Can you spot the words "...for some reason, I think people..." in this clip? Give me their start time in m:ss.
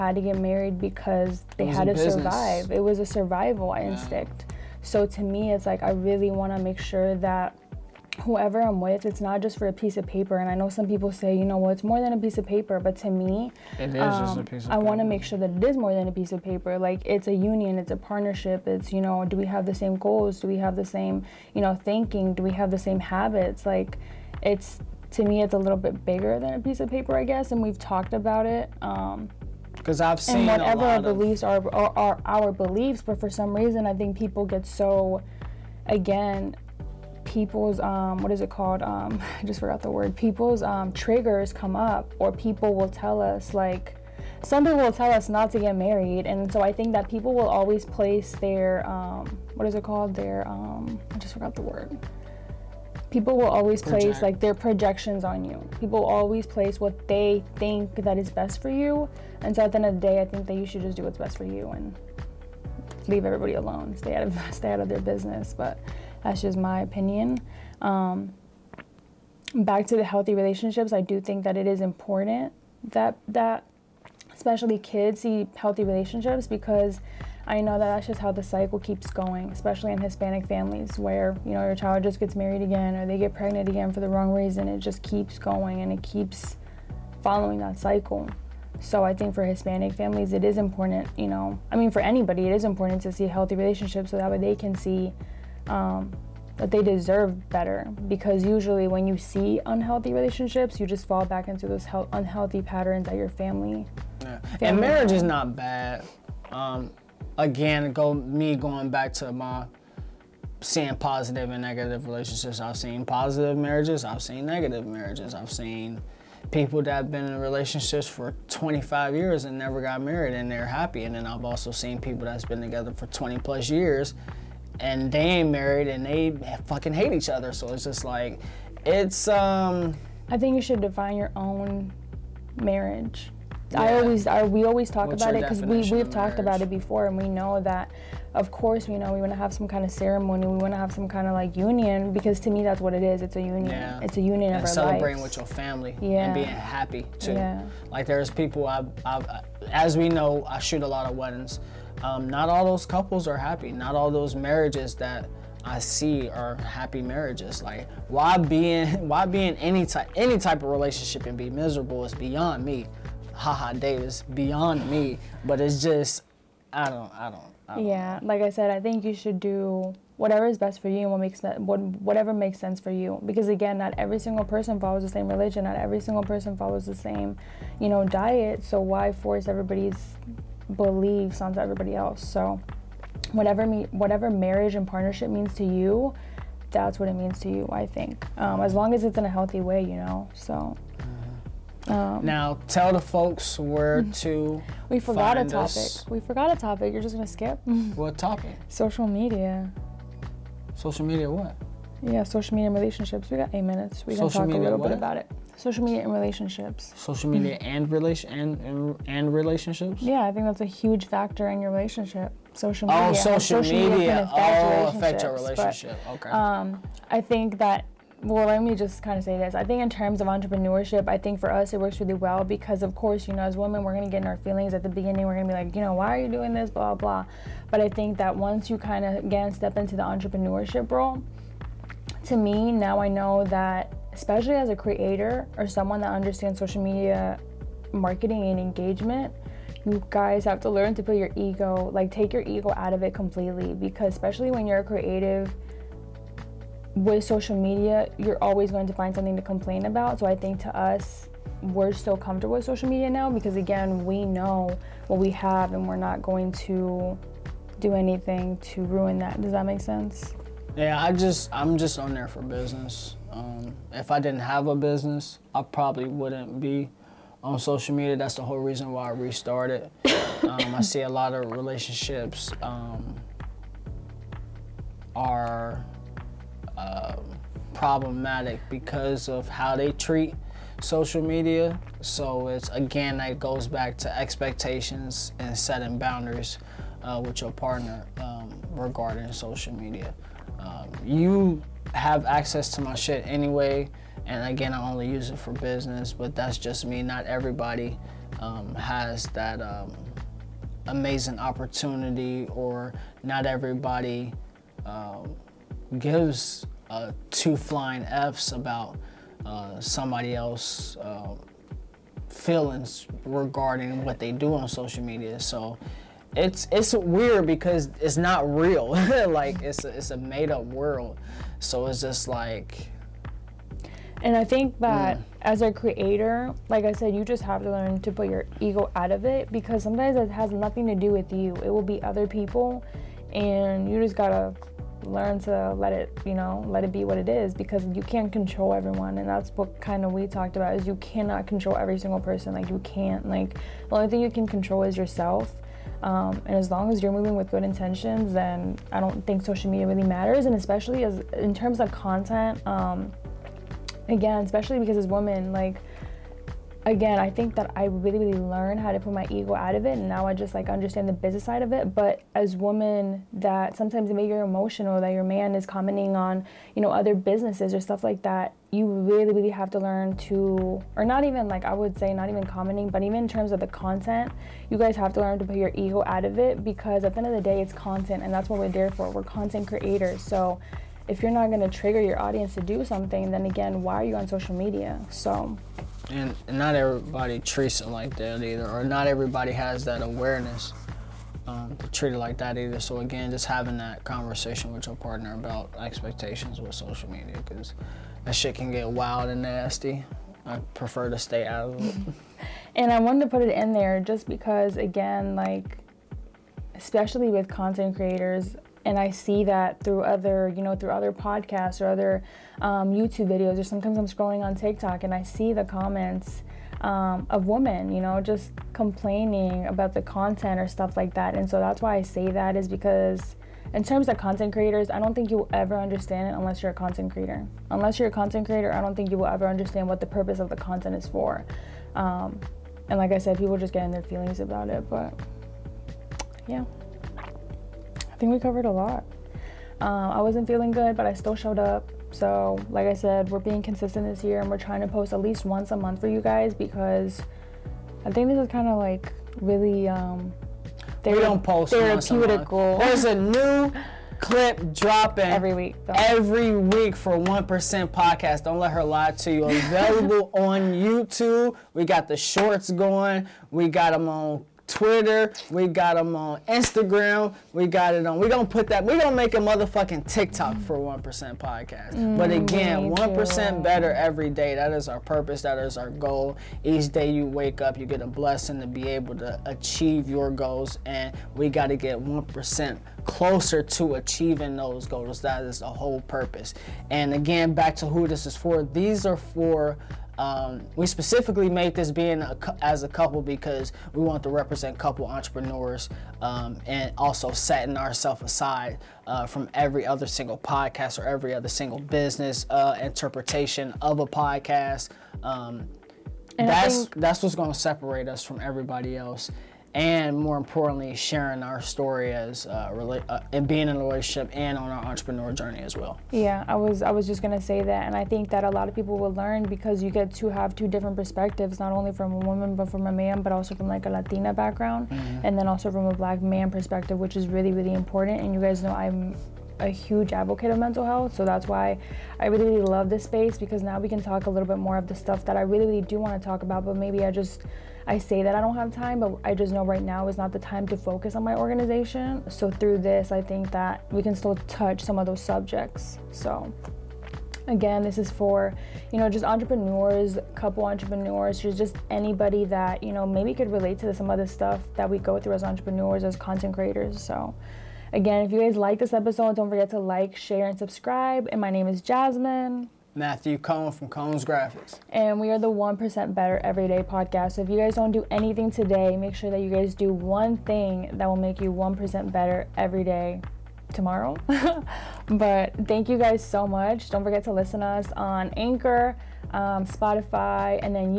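0:33.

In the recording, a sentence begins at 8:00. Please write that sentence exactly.
And we got to get 1% closer to achieving those goals.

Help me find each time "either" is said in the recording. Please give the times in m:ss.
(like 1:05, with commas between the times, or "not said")
6:28, 6:32.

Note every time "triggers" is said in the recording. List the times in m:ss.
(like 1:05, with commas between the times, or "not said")
0:40, 6:21.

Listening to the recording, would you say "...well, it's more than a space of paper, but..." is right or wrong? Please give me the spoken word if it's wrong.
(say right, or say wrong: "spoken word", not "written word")
wrong: "piece", not "space".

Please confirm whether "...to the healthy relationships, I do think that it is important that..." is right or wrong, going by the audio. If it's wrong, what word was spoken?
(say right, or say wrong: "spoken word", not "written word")
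right.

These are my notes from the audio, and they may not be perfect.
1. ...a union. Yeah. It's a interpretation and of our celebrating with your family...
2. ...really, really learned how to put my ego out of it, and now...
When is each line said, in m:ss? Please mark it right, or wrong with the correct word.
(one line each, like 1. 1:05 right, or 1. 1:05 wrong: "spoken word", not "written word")
1. 2:23 wrong: "union", not "interpretation"
2. 5:57 right.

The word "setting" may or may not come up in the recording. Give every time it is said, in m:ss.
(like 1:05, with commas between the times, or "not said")
4:45, 8:17.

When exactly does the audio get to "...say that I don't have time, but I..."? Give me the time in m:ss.
8:57.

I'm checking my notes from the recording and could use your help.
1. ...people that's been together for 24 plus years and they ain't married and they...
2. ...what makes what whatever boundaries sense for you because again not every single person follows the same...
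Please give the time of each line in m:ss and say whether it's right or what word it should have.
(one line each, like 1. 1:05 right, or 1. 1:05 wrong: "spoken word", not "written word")
1. 2:01 wrong: "20", not "24"
2. 2:51 wrong: "makes", not "boundaries".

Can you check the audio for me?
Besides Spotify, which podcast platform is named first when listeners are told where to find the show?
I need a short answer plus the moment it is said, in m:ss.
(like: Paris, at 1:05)
Anchor, at 9:38.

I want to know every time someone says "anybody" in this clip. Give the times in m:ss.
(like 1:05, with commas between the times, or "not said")
1:31, 9:11.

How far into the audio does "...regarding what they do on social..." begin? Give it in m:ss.
5:13.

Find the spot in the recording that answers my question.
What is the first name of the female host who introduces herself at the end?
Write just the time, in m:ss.
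9:21.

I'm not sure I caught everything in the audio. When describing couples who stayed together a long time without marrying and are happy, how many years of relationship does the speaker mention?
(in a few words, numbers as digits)
25 years.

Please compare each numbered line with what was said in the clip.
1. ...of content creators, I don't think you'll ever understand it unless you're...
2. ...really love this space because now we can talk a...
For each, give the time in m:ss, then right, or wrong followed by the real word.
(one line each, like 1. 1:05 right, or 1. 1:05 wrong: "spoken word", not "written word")
1. 7:04 right
2. 8:52 right.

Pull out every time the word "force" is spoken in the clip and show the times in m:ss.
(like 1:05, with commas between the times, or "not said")
2:59.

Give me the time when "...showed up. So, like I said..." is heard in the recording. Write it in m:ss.
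7:21.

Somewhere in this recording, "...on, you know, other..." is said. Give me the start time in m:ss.
6:06.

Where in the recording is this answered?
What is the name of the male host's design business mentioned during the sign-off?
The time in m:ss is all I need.
9:23.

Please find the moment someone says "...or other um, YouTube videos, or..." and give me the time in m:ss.
6:51.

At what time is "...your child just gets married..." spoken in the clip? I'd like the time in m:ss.
1:21.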